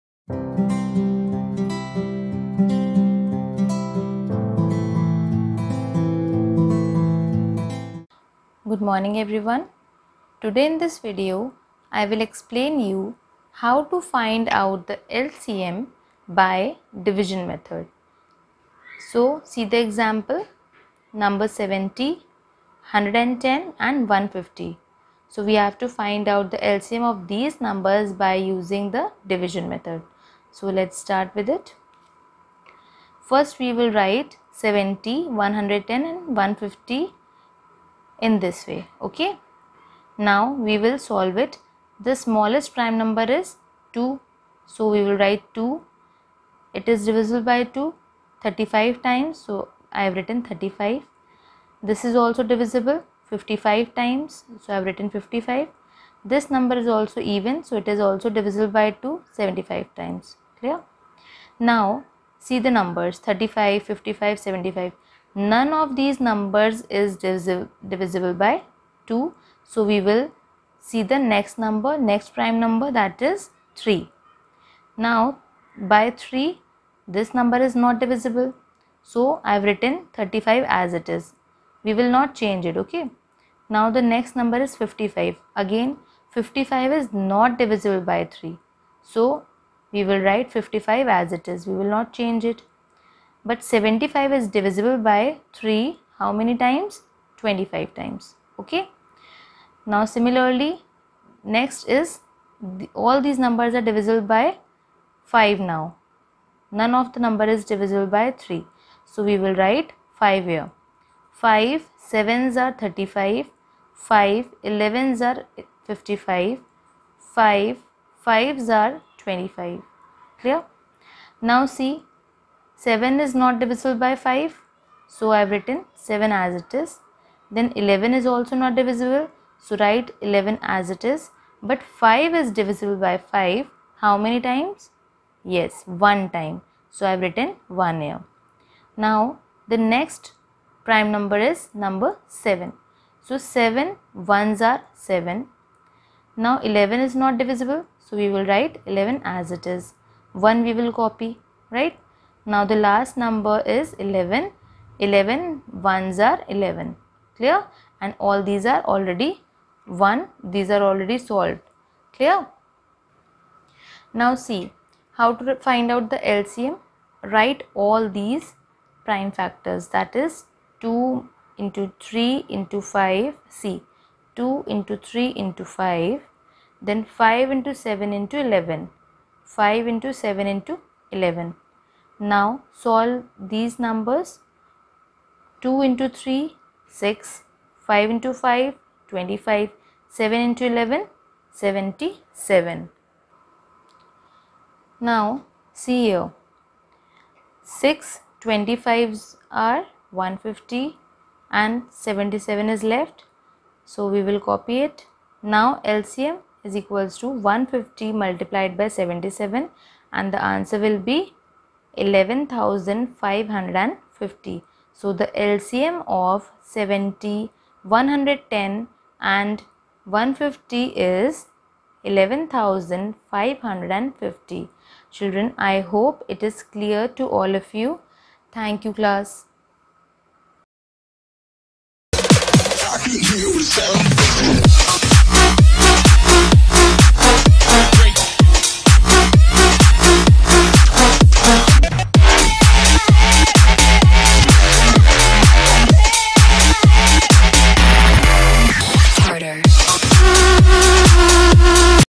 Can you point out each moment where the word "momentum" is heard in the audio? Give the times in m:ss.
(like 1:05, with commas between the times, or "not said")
not said.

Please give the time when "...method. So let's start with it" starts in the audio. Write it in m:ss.
0:29.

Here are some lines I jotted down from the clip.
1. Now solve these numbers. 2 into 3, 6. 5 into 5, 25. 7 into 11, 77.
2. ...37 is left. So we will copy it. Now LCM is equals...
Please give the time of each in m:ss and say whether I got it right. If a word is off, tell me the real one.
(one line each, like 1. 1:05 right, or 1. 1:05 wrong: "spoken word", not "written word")
1. 3:02 right
2. 3:21 wrong: "77", not "37".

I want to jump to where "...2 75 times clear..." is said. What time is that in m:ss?
0:58.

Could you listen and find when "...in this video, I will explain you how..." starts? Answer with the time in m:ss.
0:10.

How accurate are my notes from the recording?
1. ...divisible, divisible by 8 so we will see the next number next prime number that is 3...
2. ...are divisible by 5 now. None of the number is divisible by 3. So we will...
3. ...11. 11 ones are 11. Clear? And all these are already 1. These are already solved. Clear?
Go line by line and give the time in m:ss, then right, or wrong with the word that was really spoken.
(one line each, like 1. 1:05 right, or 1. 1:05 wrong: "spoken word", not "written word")
1. 1:07 wrong: "2", not "8"
2. 1:43 right
3. 2:33 right.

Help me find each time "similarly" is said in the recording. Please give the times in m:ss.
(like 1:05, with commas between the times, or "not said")
1:40.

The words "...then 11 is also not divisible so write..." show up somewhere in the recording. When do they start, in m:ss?
2:07.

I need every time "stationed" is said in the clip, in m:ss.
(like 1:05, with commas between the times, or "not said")
not said.